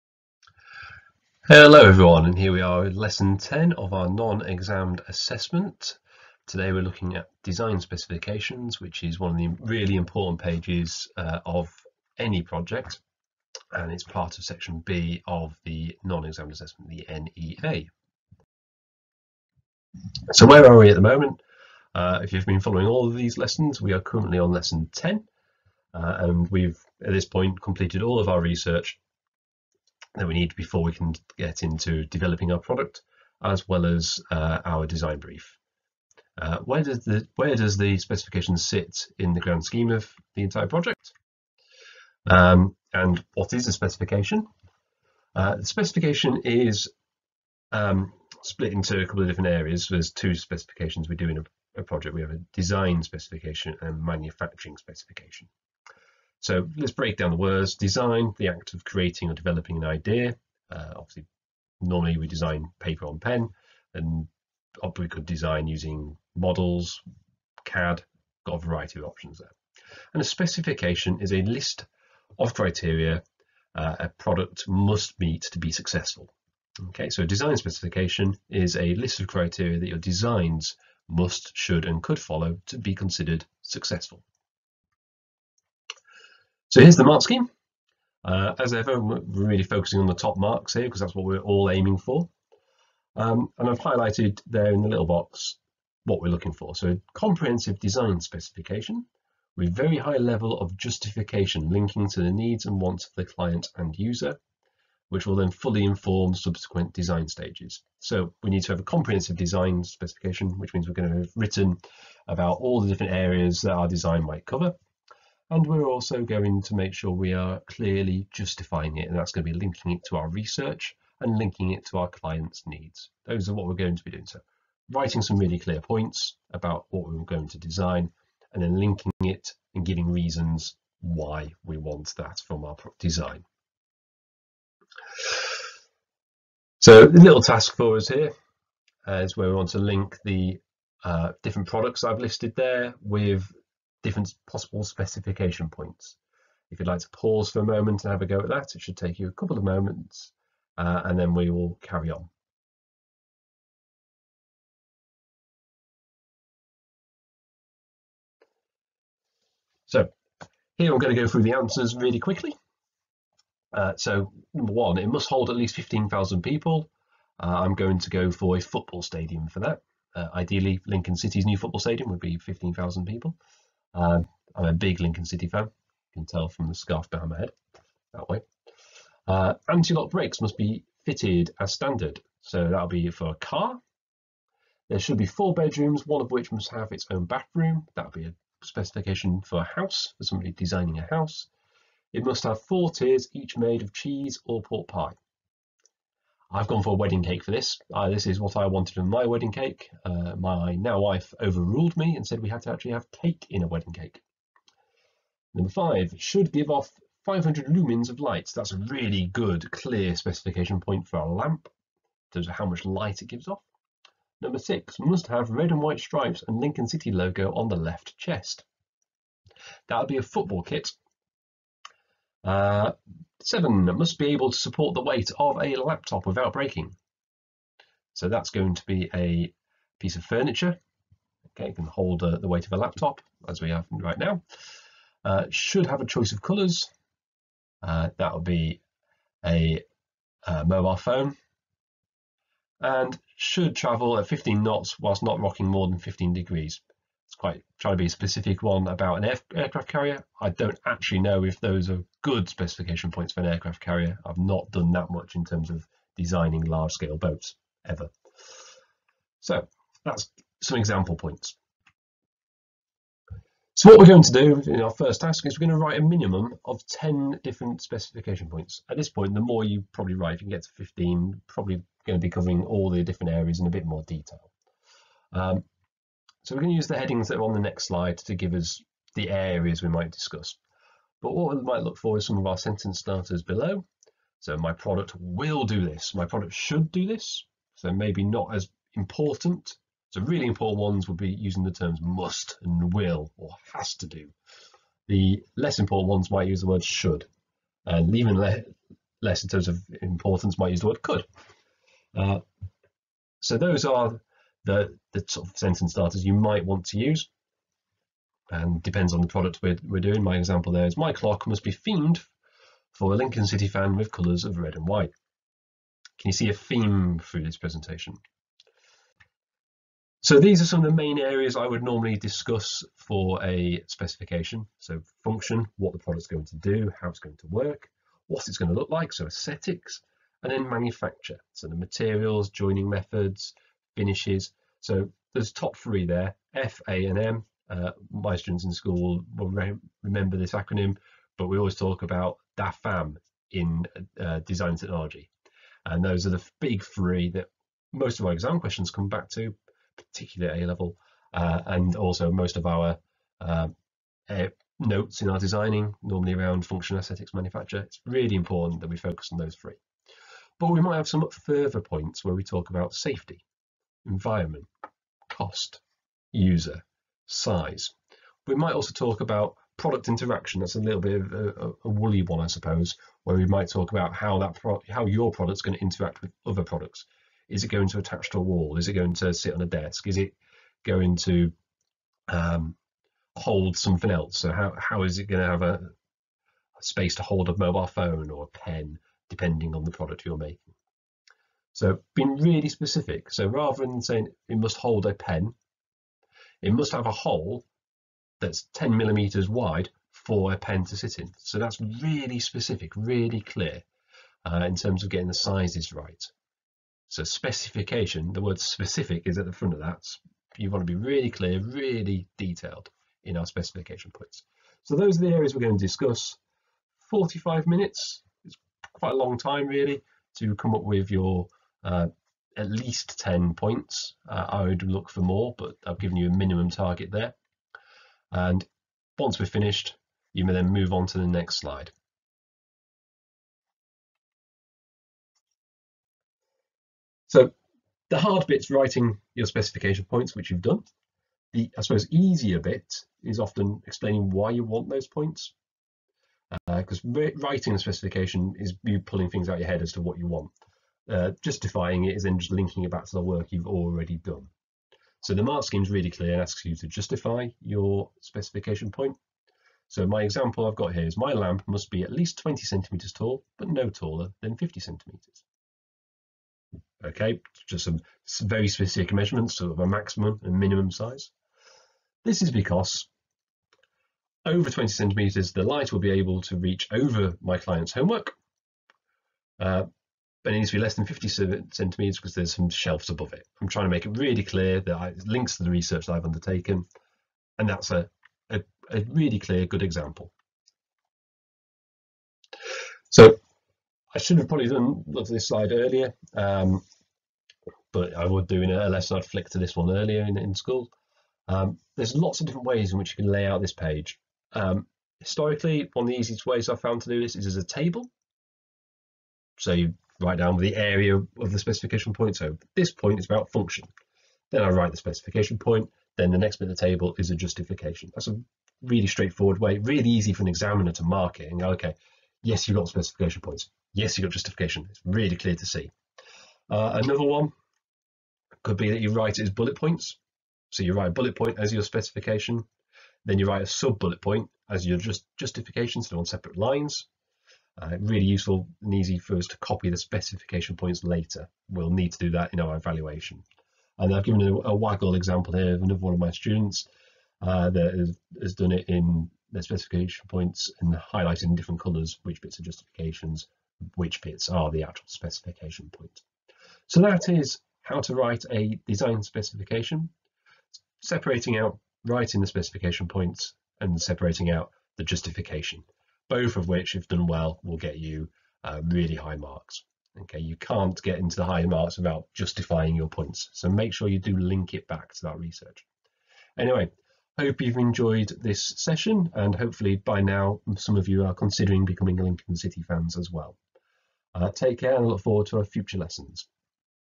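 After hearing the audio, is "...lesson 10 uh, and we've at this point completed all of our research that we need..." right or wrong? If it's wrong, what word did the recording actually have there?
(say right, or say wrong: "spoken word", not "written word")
right.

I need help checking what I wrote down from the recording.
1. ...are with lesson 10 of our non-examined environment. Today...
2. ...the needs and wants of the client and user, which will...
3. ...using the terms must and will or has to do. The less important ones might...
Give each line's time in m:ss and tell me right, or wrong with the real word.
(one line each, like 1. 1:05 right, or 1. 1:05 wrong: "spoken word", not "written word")
1. 0:02 wrong: "assessment", not "environment"
2. 1:42 right
3. 4:51 right.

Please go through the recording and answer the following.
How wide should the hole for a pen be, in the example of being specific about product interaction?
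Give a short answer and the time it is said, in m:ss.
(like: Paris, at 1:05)
10 millimetres, at 6:38.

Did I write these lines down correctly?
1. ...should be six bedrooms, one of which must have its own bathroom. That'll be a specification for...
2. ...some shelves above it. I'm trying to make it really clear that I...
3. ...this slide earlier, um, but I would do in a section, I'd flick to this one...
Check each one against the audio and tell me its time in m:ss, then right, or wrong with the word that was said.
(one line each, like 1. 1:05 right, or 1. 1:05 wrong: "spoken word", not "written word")
1. 3:04 wrong: "four", not "six"
2. 8:02 right
3. 8:15 wrong: "lesson", not "section".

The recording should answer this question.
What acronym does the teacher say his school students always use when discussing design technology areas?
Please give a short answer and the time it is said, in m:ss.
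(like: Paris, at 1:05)
DAFAM, at 5:42.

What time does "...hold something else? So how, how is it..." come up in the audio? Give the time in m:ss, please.
6:23.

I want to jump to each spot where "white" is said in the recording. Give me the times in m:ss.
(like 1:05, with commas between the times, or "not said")
3:35, 5:14.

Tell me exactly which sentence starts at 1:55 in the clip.
And we're also going to make sure we are clearly justifying it.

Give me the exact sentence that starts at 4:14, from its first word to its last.
I've not done that much in terms of designing large scale boats ever.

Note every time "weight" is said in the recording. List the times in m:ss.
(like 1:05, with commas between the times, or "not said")
3:45, 3:52.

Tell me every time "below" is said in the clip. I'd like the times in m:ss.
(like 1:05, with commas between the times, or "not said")
4:43.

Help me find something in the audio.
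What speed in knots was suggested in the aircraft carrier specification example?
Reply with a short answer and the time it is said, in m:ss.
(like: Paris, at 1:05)
15, at 4:04.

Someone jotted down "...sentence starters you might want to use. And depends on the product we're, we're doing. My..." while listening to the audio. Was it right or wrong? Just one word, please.
right.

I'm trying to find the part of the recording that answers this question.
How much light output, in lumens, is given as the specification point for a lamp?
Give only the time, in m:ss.
3:27.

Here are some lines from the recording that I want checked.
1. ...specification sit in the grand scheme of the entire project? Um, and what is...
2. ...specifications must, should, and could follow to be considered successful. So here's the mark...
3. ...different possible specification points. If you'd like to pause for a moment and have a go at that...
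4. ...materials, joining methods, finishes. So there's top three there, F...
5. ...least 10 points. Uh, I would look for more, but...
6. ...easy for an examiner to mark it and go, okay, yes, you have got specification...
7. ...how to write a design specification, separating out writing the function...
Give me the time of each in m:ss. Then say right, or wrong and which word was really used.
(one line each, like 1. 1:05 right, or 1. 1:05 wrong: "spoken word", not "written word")
1. 0:37 right
2. 1:19 wrong: "designs", not "specifications"
3. 2:24 right
4. 5:31 right
5. 7:02 right
6. 8:40 right
7. 9:17 wrong: "specification", not "function".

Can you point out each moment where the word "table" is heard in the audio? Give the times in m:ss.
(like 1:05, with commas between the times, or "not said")
8:27, 8:36.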